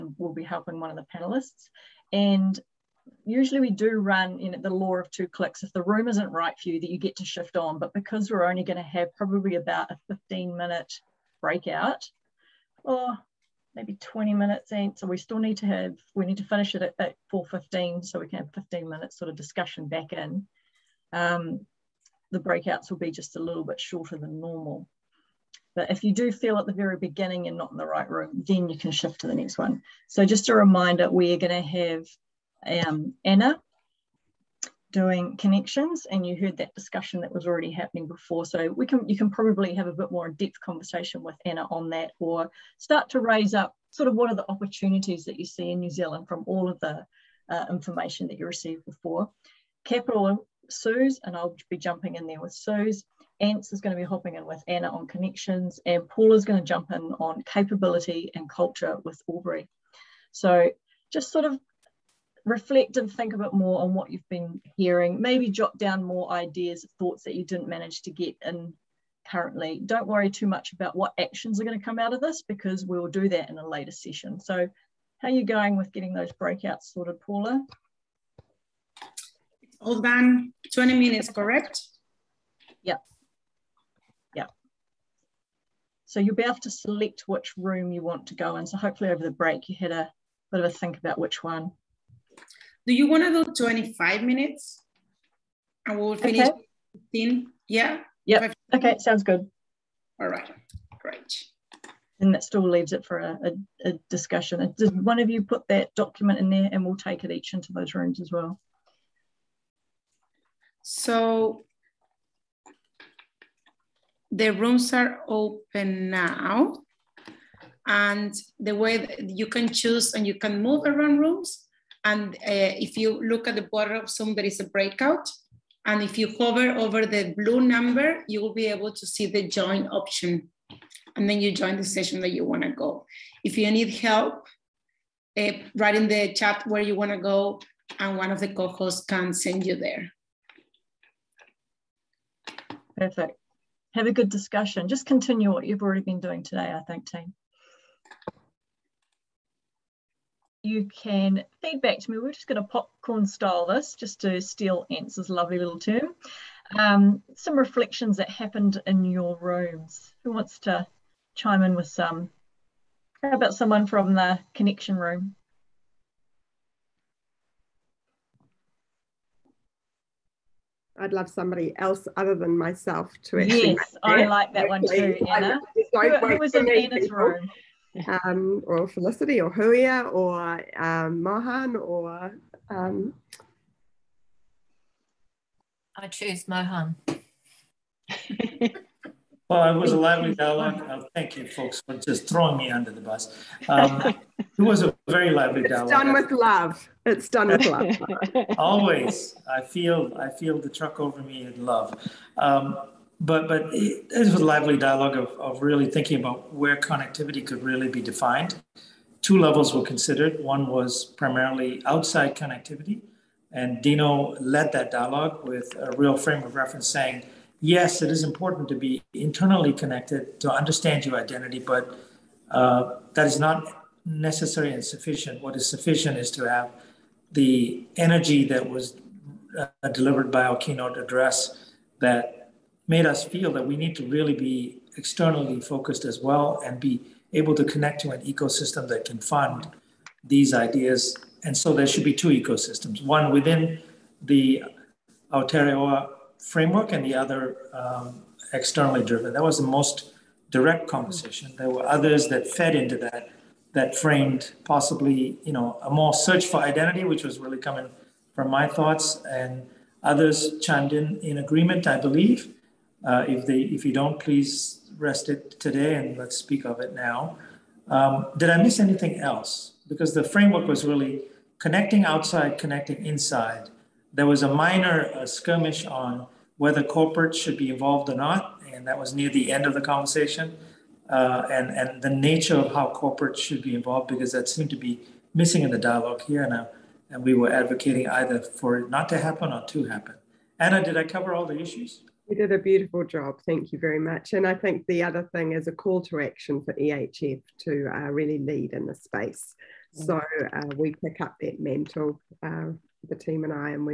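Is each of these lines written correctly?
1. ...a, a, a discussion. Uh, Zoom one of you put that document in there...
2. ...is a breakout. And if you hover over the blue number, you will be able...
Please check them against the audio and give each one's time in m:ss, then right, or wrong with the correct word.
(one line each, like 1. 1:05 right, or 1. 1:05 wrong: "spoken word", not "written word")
1. 1:43 wrong: "Did", not "Zoom"
2. 2:04 right.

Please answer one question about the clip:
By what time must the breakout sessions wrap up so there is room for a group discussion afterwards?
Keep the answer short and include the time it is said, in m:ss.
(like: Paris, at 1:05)
4.15, at 0:17.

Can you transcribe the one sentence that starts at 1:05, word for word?
Maybe jot down more ideas, thoughts that you didn't manage to get in currently.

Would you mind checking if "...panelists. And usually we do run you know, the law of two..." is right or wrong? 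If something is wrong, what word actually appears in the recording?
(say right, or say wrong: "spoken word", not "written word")
right.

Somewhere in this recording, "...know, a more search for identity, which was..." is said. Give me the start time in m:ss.
4:15.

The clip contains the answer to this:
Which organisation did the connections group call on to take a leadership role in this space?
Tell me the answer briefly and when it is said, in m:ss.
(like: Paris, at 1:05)
EHF, at 4:56.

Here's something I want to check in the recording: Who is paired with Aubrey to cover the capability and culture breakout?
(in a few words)
Paul.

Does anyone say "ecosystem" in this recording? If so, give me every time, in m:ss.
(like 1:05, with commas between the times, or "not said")
3:58, 4:02.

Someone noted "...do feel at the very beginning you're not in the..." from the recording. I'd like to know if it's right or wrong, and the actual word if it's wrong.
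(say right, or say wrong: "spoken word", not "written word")
right.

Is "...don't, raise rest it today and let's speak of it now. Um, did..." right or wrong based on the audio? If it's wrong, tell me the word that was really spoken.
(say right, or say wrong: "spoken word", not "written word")
wrong: "please", not "raise".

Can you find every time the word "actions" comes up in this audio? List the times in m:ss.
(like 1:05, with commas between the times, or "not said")
1:11, 4:56.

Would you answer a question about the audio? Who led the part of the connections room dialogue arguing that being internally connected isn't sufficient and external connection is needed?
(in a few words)
Dino.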